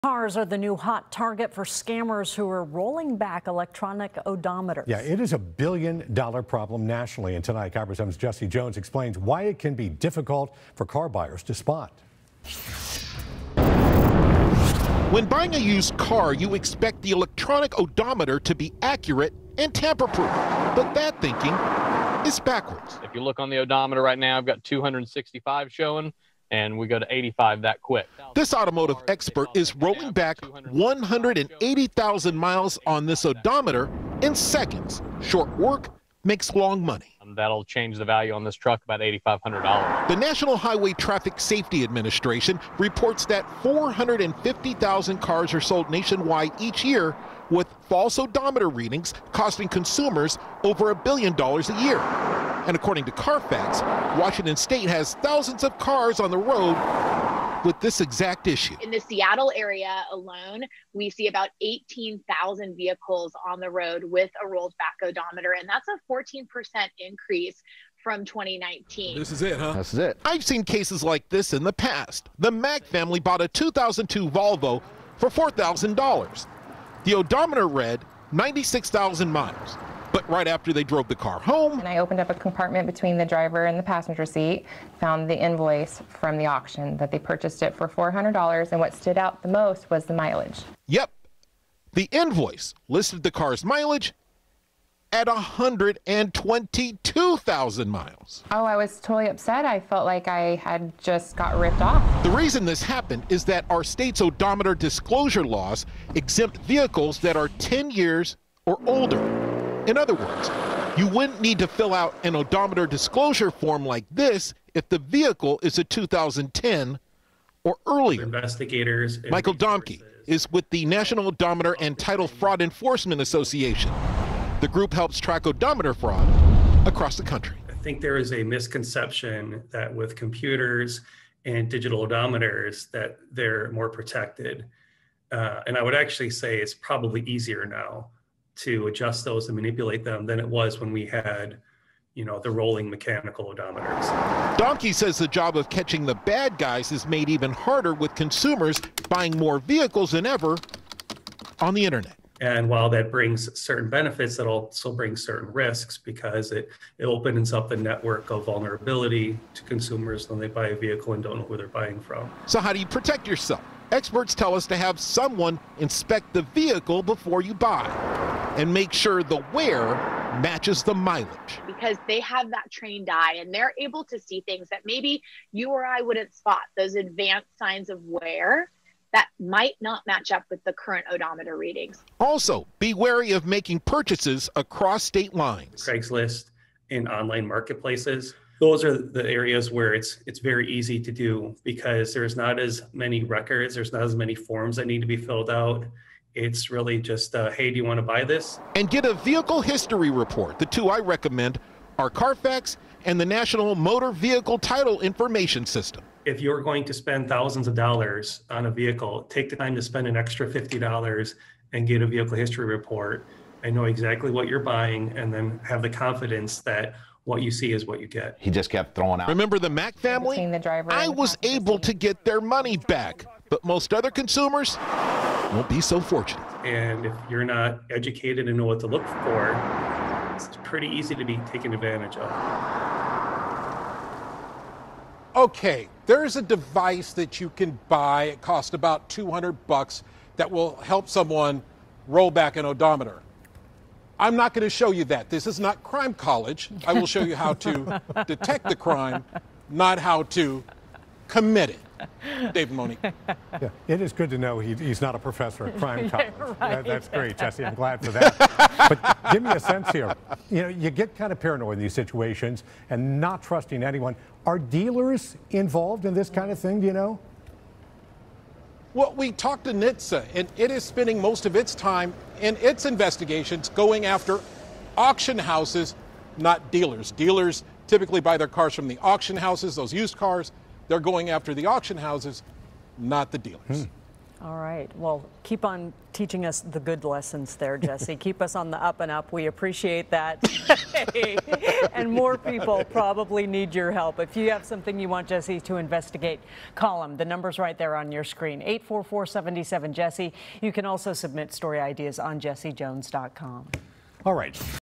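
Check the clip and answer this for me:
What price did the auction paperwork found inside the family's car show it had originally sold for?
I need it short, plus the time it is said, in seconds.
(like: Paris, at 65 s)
$400, at 87 s.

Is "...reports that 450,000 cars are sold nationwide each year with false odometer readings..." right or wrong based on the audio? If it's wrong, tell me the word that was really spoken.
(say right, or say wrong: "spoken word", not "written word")
right.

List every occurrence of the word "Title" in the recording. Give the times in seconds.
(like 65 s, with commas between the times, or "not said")
121 s, 204 s.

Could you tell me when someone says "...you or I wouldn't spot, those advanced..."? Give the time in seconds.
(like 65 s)
175 s.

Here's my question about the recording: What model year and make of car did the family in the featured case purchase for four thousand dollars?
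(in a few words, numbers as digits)
2002 Volvo.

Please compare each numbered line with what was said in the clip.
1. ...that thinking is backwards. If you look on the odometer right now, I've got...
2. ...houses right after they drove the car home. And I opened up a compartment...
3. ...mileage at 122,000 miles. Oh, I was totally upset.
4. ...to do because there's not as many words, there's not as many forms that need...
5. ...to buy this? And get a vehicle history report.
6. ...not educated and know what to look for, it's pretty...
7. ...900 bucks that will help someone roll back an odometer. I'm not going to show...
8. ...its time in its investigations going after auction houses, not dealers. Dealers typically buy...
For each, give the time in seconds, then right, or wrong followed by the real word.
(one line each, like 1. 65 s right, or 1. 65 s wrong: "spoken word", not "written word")
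1. 20 s right
2. 79 s wrong: "miles", not "houses"
3. 93 s right
4. 190 s wrong: "records", not "words"
5. 197 s right
6. 227 s right
7. 239 s wrong: "200", not "900"
8. 271 s right.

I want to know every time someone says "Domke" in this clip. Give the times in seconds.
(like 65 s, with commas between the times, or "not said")
119 s, 144 s.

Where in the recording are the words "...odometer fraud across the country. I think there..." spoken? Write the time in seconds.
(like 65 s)
125 s.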